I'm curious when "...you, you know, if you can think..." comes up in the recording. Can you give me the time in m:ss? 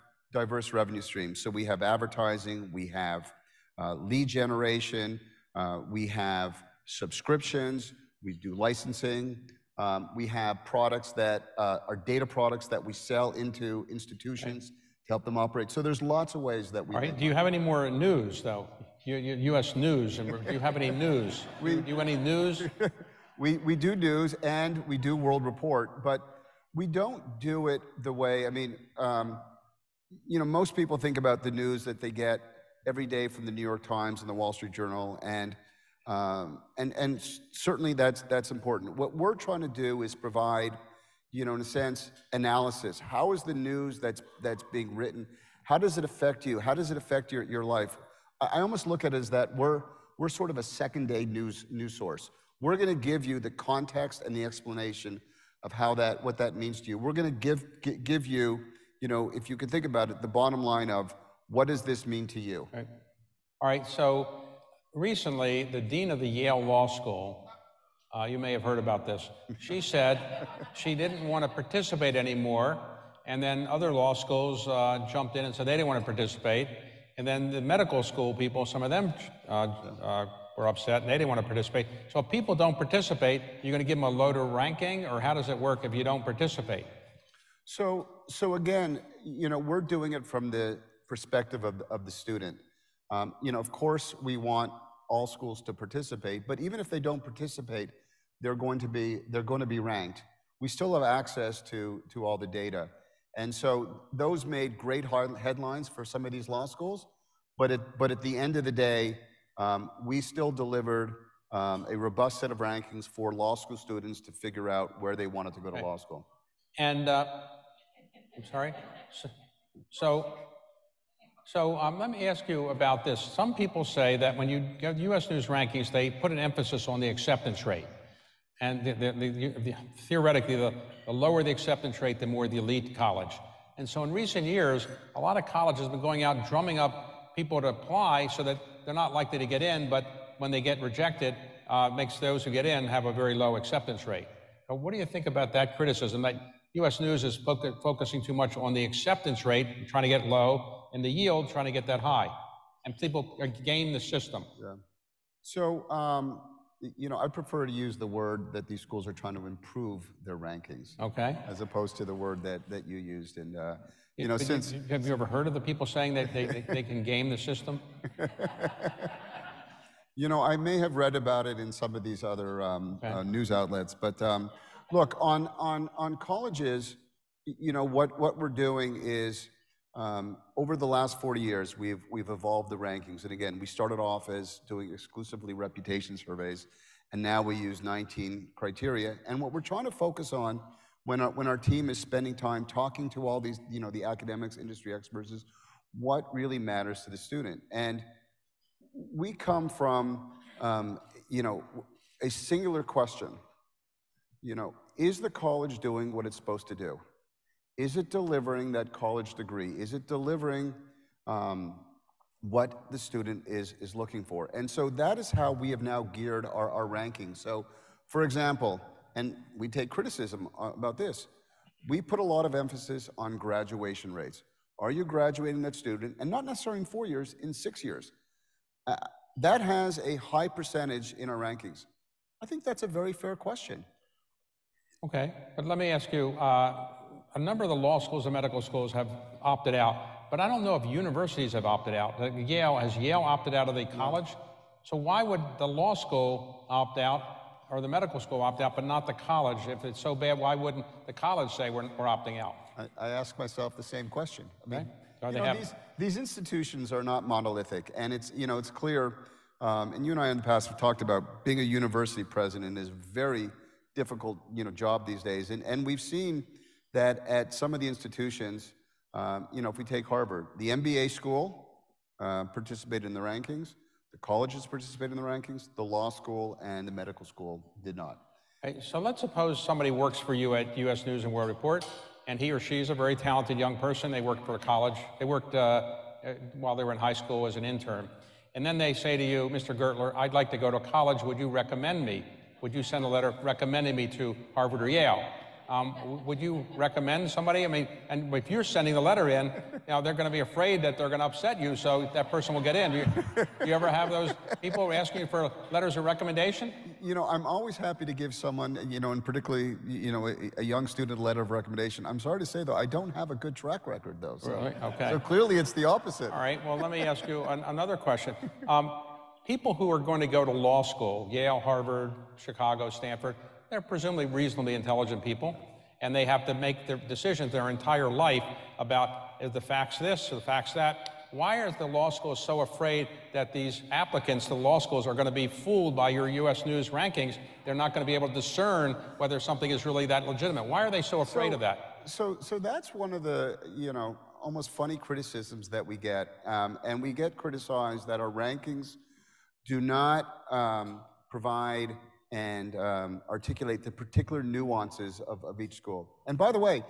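0:58.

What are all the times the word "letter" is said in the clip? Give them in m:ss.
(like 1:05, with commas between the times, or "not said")
4:53, 4:58, 5:05, 5:11.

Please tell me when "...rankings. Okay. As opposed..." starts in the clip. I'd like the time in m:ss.
2:40.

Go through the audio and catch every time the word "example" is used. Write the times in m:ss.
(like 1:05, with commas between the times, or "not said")
3:38.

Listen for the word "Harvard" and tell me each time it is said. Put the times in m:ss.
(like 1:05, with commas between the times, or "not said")
4:30, 4:54, 5:21.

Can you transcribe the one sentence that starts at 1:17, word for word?
And then the medical school people, some of them uh, uh were upset and they didn't want to participate.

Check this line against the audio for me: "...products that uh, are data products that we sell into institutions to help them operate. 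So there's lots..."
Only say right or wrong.
right.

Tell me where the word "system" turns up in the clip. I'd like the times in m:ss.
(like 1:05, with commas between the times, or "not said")
2:33, 2:47.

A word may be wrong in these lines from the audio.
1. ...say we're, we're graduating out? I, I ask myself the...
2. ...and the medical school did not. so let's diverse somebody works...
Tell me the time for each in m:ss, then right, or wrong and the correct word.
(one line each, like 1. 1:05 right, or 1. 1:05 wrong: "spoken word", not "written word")
1. 4:11 wrong: "opting", not "graduating"
2. 4:36 wrong: "suppose", not "diverse".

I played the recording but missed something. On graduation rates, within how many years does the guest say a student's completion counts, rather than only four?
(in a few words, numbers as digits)
6 years.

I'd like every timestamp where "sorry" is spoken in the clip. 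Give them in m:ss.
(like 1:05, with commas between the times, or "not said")
1:58, 5:12.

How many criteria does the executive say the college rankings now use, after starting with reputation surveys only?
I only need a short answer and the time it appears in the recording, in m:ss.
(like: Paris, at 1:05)
19, at 3:07.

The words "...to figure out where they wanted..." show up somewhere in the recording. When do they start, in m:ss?
1:54.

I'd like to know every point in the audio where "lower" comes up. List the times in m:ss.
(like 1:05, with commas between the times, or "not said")
1:24, 2:11.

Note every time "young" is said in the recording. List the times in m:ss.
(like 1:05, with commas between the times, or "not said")
4:43, 5:10.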